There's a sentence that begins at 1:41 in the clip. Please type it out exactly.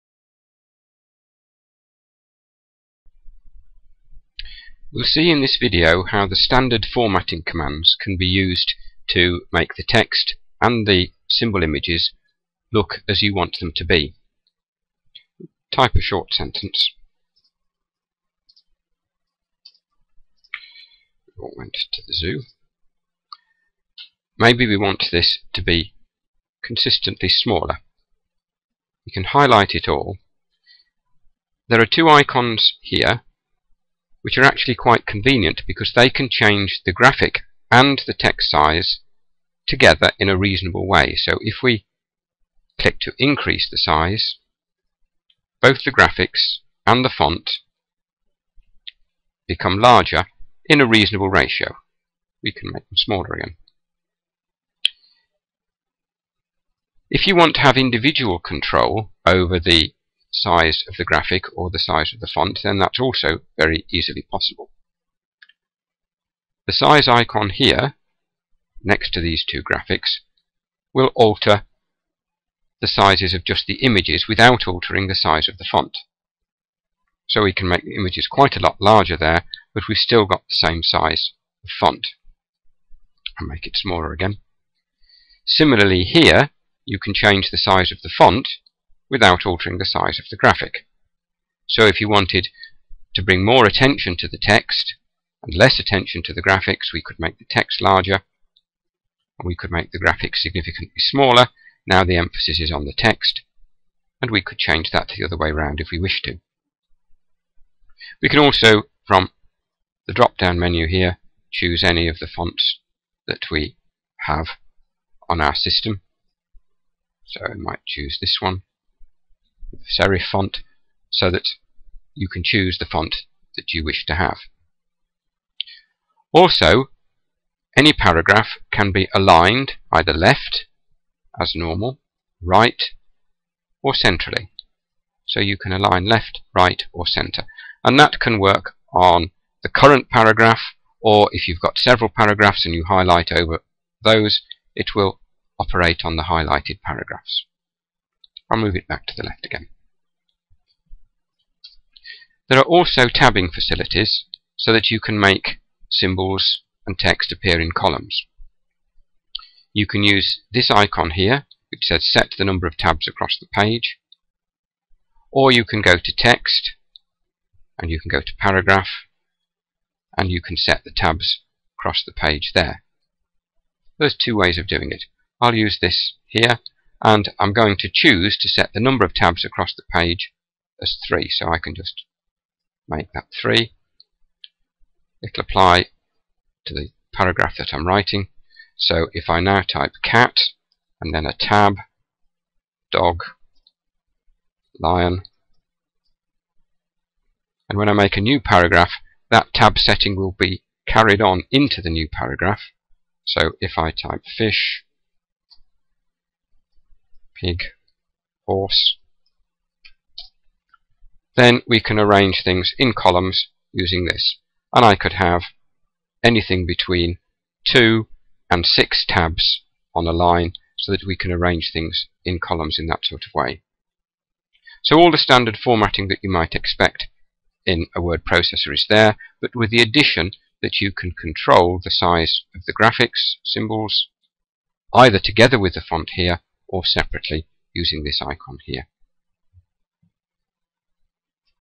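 Now the emphasis is on the text and we could change that the other way around if we wish to.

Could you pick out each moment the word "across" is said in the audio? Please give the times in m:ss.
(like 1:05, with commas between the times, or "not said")
2:43, 2:51, 2:59.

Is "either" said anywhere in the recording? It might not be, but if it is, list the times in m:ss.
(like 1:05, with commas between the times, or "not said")
2:09, 3:54.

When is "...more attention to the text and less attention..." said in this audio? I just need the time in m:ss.
1:33.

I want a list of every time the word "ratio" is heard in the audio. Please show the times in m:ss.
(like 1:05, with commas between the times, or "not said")
0:51.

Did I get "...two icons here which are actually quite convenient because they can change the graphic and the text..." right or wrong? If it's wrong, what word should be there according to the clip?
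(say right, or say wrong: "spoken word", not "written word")
right.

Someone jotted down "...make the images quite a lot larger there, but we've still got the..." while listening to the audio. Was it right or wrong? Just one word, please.
right.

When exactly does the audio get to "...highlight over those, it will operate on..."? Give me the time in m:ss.
2:22.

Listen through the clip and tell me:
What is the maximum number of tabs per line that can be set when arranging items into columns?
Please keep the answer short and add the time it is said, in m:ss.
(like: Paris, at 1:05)
6, at 3:38.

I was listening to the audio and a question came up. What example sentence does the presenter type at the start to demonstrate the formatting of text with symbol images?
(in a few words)
We all went to the zoo.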